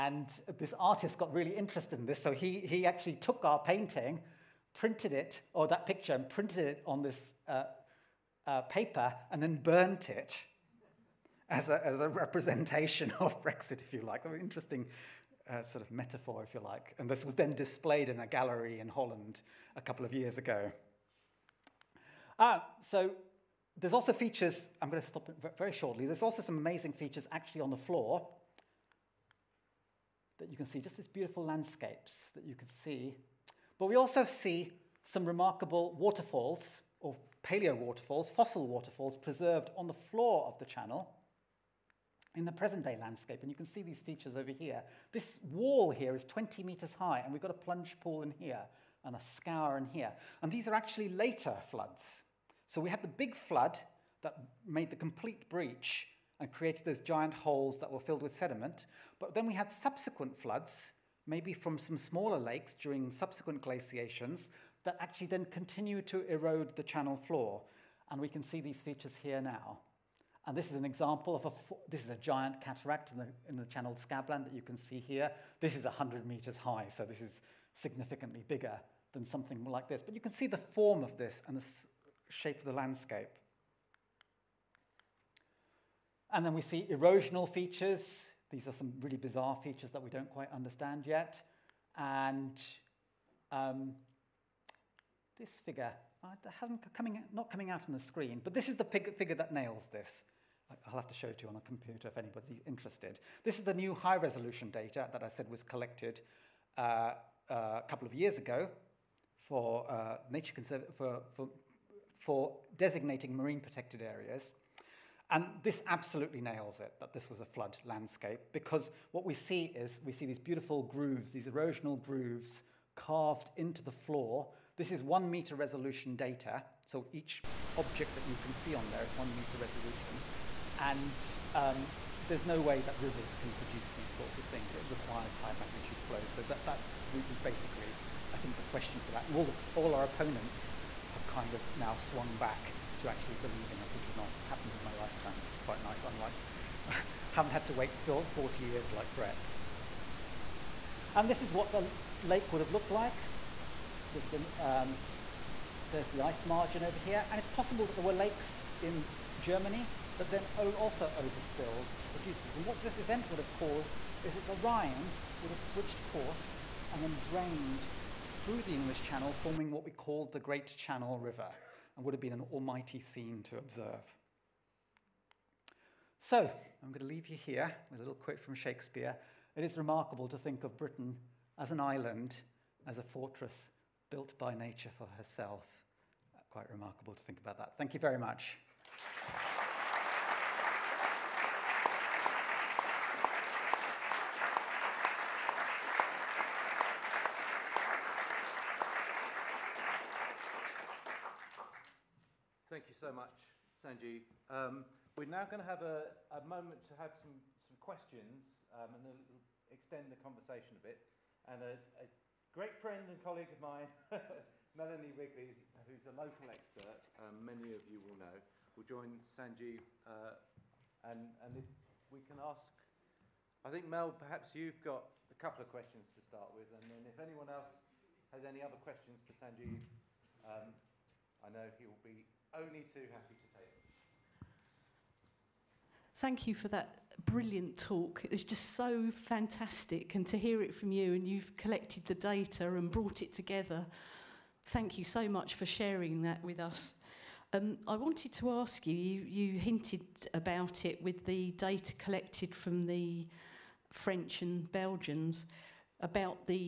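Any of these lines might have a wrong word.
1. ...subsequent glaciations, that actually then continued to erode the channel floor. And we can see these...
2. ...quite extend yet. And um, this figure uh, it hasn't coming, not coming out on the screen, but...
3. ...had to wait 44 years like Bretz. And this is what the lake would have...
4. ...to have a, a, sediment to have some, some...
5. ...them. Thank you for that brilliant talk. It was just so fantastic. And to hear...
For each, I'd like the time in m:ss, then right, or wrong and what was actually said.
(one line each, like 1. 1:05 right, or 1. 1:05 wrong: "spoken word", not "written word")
1. 1:03 right
2. 1:30 wrong: "understand", not "extend"
3. 2:27 wrong: "40", not "44"
4. 3:25 wrong: "moment", not "sediment"
5. 3:53 right.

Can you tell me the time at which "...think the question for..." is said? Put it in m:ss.
2:18.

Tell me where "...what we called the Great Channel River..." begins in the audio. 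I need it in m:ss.
2:49.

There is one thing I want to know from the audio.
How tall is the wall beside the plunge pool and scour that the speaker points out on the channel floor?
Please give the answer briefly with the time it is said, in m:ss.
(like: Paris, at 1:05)
20 meters, at 0:46.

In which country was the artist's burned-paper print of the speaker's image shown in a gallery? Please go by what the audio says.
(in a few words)
Holland.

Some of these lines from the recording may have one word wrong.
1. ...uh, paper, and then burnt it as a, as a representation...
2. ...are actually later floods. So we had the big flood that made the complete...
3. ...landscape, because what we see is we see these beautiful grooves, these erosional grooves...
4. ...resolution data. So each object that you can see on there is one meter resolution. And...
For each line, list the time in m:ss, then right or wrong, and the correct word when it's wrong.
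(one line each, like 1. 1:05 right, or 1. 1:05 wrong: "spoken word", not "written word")
1. 0:08 right
2. 0:50 right
3. 1:57 right
4. 2:05 right.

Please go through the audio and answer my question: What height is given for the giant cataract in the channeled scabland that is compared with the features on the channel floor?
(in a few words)
100 meters.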